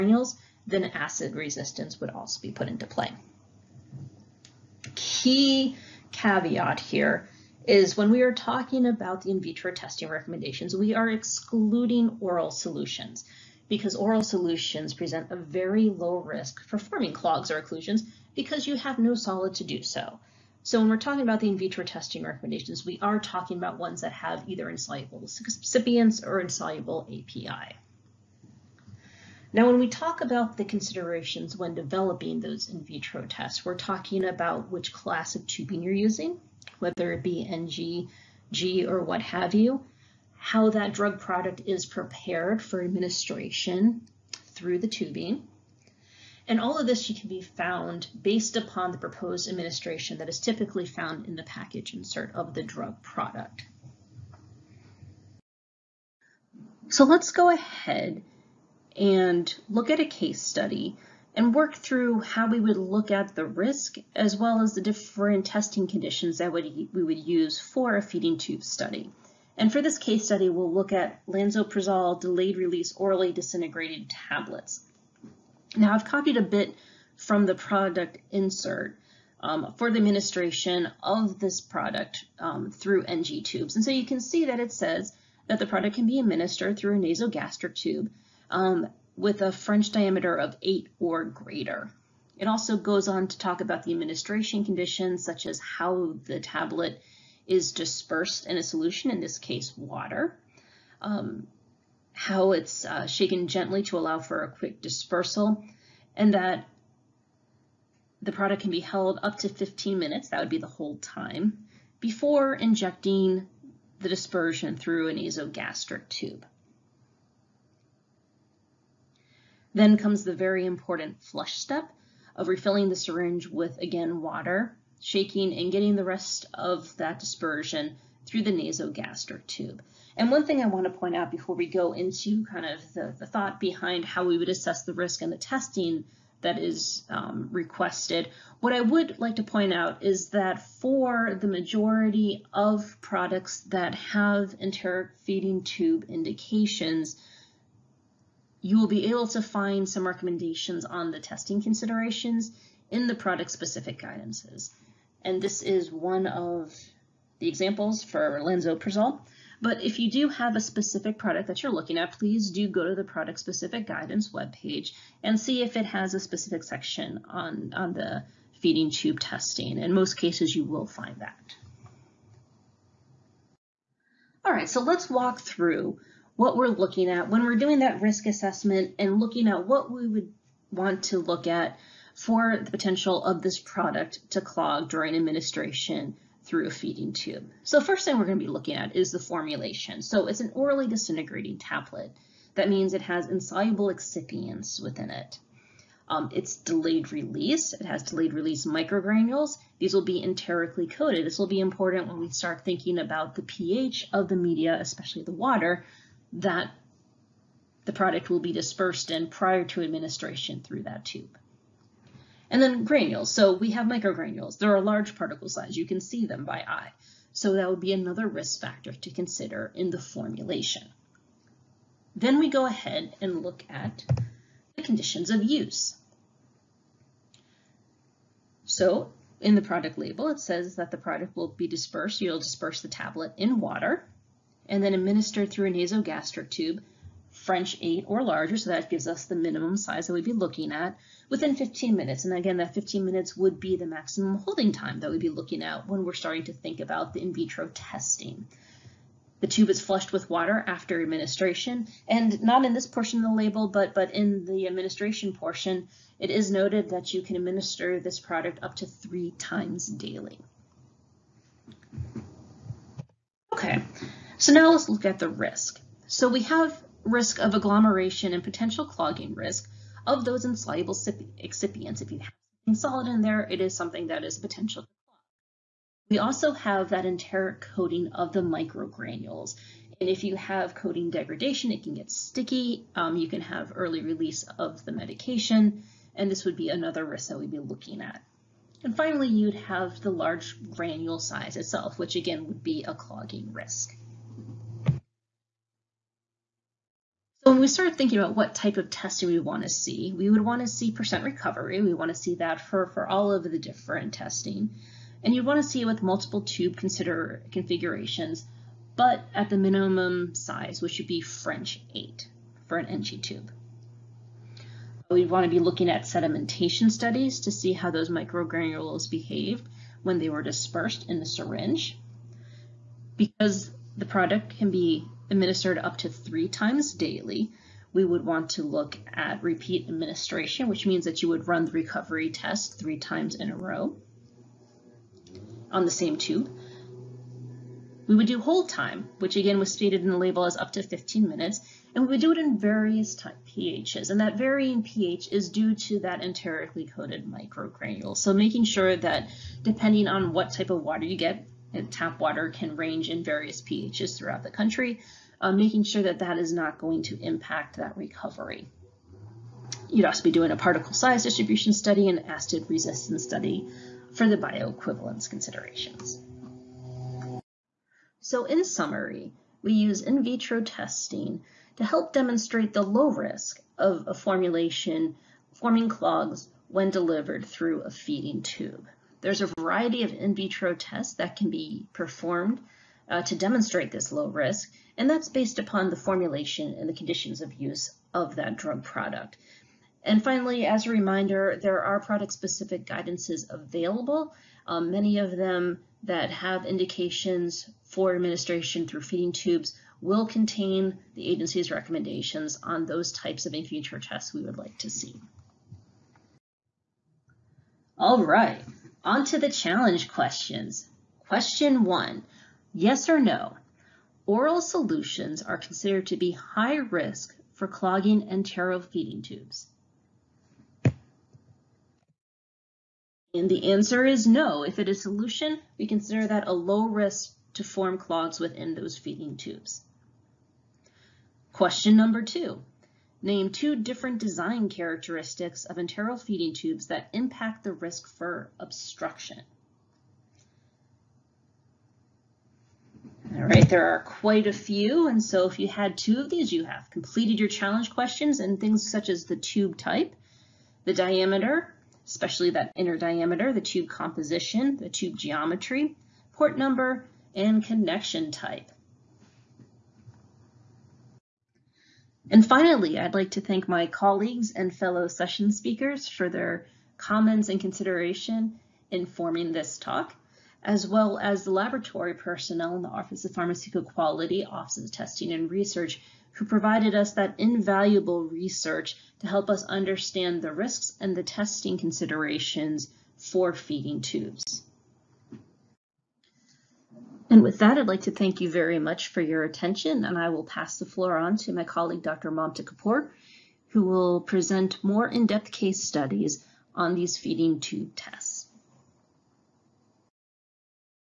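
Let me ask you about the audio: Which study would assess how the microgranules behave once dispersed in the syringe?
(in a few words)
Sedimentation studies.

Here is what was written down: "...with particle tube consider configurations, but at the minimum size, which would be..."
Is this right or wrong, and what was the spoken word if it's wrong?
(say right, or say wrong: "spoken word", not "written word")
wrong: "multiple", not "particle".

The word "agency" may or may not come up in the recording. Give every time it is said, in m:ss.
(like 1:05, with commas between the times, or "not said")
6:41.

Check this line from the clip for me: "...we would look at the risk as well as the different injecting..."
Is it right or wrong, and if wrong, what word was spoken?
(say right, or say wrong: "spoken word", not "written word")
wrong: "testing", not "injecting".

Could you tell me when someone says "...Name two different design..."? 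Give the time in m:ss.
7:13.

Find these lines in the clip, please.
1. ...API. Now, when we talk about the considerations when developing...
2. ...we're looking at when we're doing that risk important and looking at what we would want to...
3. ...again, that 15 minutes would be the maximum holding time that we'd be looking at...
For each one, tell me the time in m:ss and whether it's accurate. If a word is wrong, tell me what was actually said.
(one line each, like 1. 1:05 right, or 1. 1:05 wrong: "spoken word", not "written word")
1. 0:27 right
2. 2:56 wrong: "assessment", not "important"
3. 4:02 right.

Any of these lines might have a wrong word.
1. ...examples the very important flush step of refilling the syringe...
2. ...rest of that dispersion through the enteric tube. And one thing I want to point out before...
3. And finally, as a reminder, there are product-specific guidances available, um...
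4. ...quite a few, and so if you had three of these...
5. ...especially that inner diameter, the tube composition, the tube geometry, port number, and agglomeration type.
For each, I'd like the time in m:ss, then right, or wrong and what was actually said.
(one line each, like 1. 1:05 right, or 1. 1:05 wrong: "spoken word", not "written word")
1. 1:59 wrong: "comes", not "examples"
2. 2:06 wrong: "nasogastric", not "enteric"
3. 6:30 right
4. 7:24 wrong: "two", not "three"
5. 7:32 wrong: "connection", not "agglomeration".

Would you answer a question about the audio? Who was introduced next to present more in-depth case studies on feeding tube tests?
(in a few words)
Mamta Kapoor.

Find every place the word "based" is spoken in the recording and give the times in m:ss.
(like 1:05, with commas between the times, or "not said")
0:48, 6:25.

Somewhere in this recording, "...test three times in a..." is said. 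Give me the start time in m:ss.
5:32.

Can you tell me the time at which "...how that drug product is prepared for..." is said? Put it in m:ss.
0:40.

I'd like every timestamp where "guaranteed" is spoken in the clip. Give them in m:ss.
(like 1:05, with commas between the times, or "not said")
not said.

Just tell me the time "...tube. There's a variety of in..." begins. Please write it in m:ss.
6:18.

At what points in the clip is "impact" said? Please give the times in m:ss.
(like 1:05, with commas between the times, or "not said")
5:57, 7:17.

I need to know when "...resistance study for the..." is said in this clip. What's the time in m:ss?
6:02.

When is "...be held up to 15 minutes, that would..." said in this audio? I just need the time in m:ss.
1:48.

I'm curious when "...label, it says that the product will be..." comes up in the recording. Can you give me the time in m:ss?
3:49.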